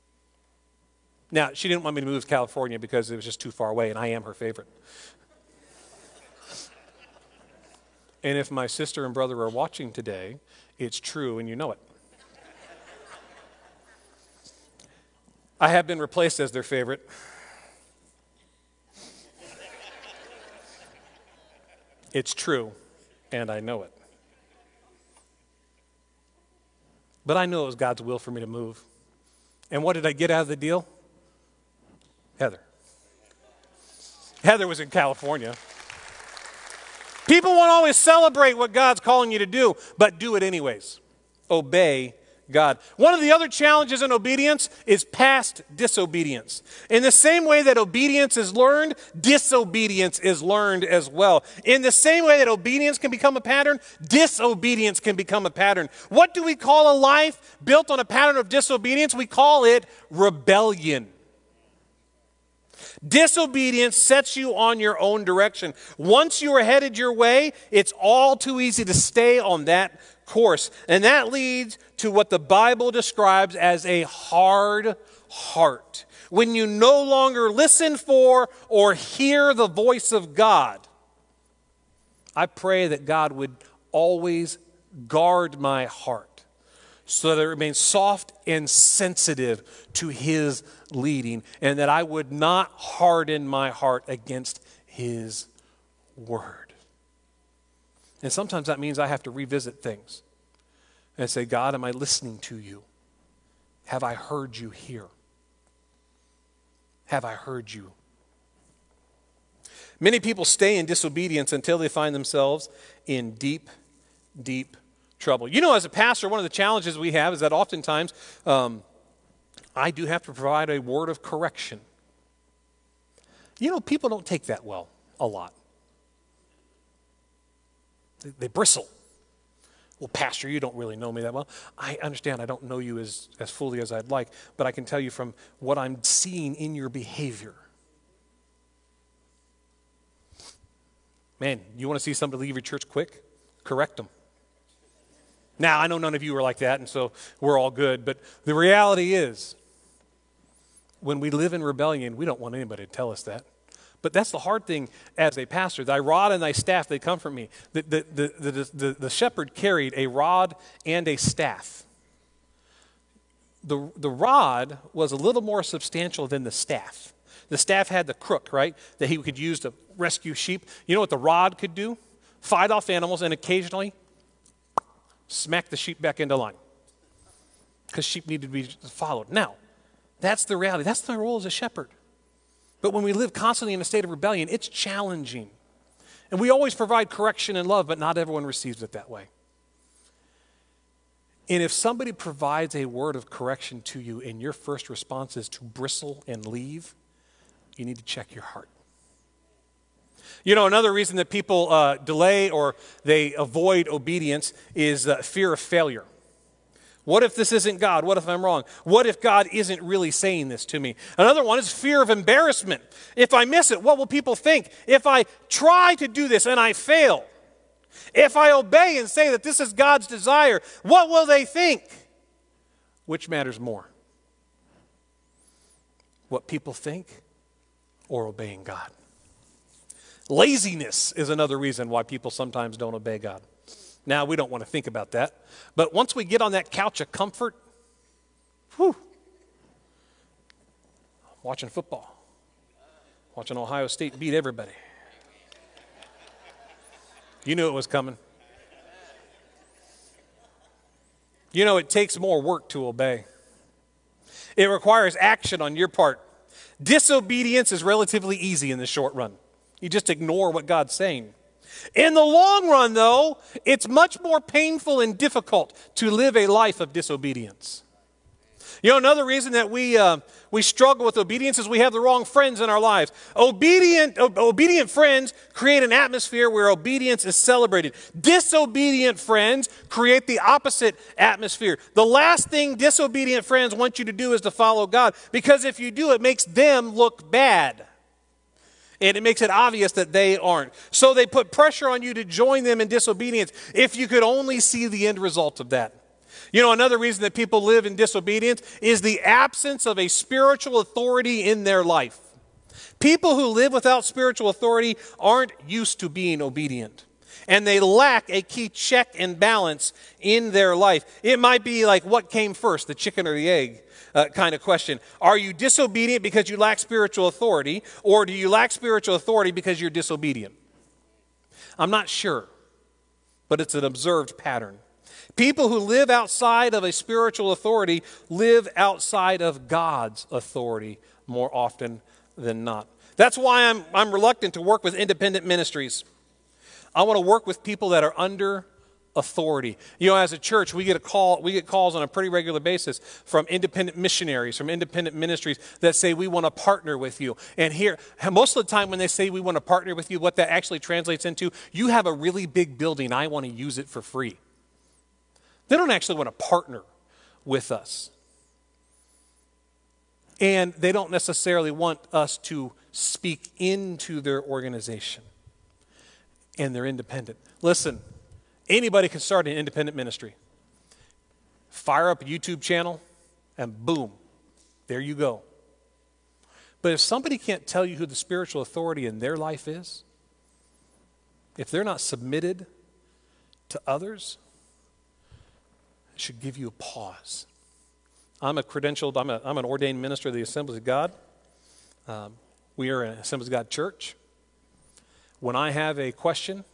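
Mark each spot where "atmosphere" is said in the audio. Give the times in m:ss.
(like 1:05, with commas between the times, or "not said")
4:35, 4:41.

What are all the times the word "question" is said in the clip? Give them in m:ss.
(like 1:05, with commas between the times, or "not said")
5:14, 6:36.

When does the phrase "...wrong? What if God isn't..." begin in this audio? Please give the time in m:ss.
3:28.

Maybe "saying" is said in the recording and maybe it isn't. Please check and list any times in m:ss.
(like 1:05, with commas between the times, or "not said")
3:30, 4:20.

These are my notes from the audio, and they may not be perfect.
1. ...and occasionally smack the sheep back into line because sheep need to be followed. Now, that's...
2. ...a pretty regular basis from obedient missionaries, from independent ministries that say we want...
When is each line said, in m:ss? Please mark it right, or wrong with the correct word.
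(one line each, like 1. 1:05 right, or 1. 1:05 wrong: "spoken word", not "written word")
1. 2:53 right
2. 5:42 wrong: "independent", not "obedient".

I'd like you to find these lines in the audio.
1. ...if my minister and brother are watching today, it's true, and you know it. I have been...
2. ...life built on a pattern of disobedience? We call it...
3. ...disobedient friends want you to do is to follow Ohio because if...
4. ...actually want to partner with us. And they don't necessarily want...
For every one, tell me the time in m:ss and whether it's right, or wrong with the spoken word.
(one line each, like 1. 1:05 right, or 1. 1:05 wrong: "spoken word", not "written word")
1. 0:08 wrong: "sister", not "minister"
2. 0:56 right
3. 4:42 wrong: "God", not "Ohio"
4. 5:55 right.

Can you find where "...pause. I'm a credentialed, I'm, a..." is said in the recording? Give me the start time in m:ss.
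6:26.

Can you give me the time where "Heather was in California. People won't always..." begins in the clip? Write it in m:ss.
0:34.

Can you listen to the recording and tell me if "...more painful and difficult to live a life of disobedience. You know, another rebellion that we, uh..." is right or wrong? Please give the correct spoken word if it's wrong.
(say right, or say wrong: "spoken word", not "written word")
wrong: "reason", not "rebellion".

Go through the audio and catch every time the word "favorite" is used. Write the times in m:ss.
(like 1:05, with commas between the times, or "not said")
0:04, 0:16.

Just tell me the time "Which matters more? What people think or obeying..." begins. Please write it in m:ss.
3:43.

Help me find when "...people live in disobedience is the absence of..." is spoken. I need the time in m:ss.
4:57.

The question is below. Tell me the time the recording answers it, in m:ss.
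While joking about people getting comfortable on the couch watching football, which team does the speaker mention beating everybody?
4:03.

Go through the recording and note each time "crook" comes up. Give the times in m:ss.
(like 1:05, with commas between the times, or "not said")
2:48.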